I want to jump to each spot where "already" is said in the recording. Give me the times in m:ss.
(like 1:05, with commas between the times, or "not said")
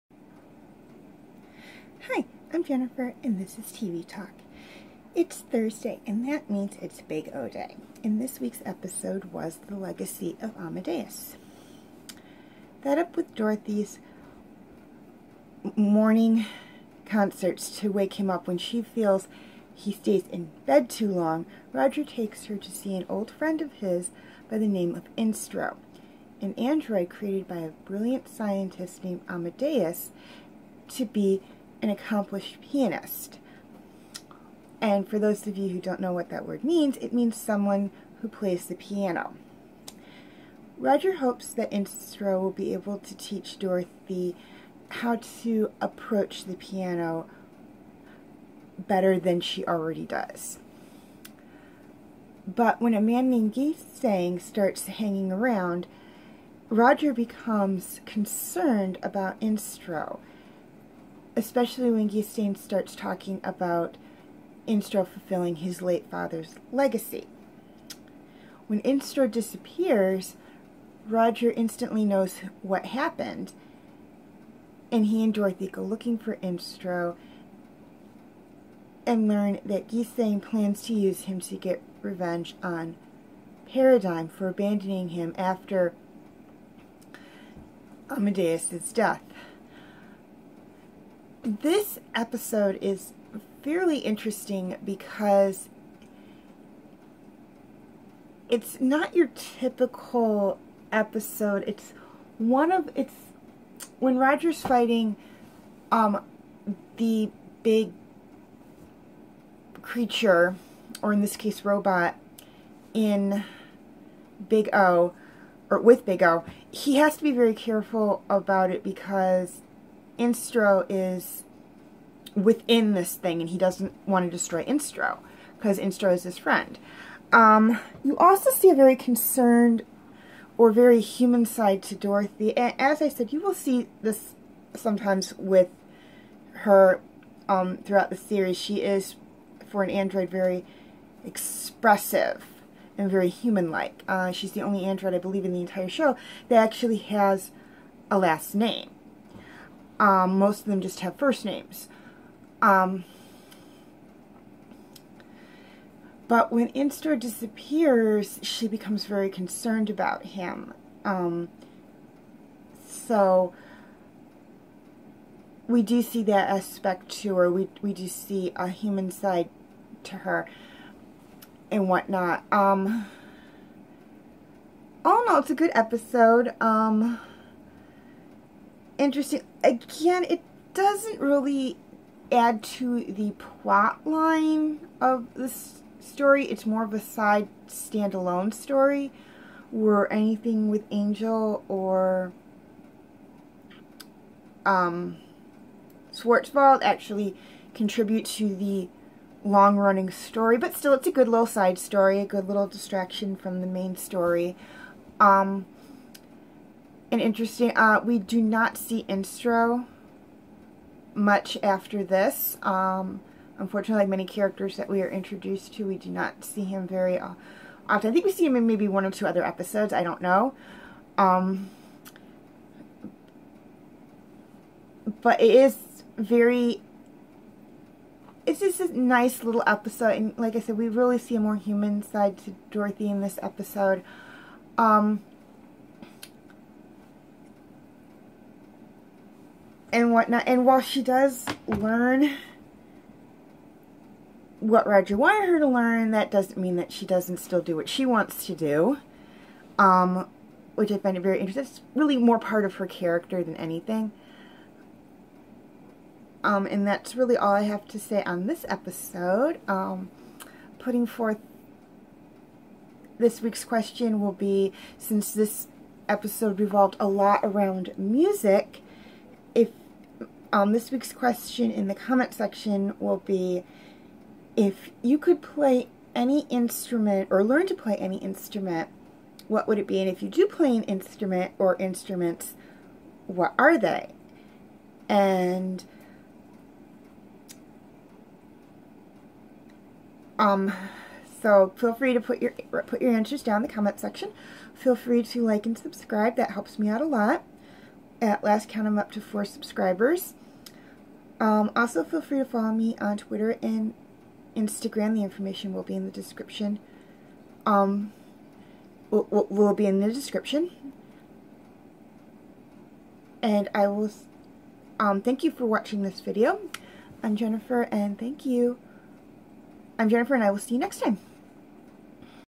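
0:49.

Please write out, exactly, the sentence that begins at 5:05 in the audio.
The information will be in the description.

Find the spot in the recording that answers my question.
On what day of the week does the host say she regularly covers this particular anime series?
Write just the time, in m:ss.
0:05.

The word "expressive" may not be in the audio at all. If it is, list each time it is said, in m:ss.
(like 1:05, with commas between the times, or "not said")
2:21.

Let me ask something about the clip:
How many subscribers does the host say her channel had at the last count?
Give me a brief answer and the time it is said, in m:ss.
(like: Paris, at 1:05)
4, at 4:59.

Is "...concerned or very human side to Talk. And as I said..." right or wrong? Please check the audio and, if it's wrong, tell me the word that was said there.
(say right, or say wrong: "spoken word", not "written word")
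wrong: "Dorothy", not "Talk".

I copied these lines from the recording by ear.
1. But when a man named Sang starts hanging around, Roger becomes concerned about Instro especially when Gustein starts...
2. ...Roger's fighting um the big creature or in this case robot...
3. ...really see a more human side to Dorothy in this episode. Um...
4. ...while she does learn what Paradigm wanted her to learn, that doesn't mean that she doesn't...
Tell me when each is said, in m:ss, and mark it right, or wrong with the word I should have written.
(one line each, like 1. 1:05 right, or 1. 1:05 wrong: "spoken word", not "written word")
1. 0:52 right
2. 1:44 right
3. 3:50 right
4. 4:00 wrong: "Roger", not "Paradigm".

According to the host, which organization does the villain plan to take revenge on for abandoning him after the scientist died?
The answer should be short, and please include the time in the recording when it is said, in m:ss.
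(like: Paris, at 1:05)
Paradigm, at 1:23.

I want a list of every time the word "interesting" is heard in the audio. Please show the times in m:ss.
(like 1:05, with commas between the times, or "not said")
1:33, 2:59, 3:27, 4:11.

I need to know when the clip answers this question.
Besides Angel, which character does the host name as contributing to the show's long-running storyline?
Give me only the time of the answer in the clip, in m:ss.
3:16.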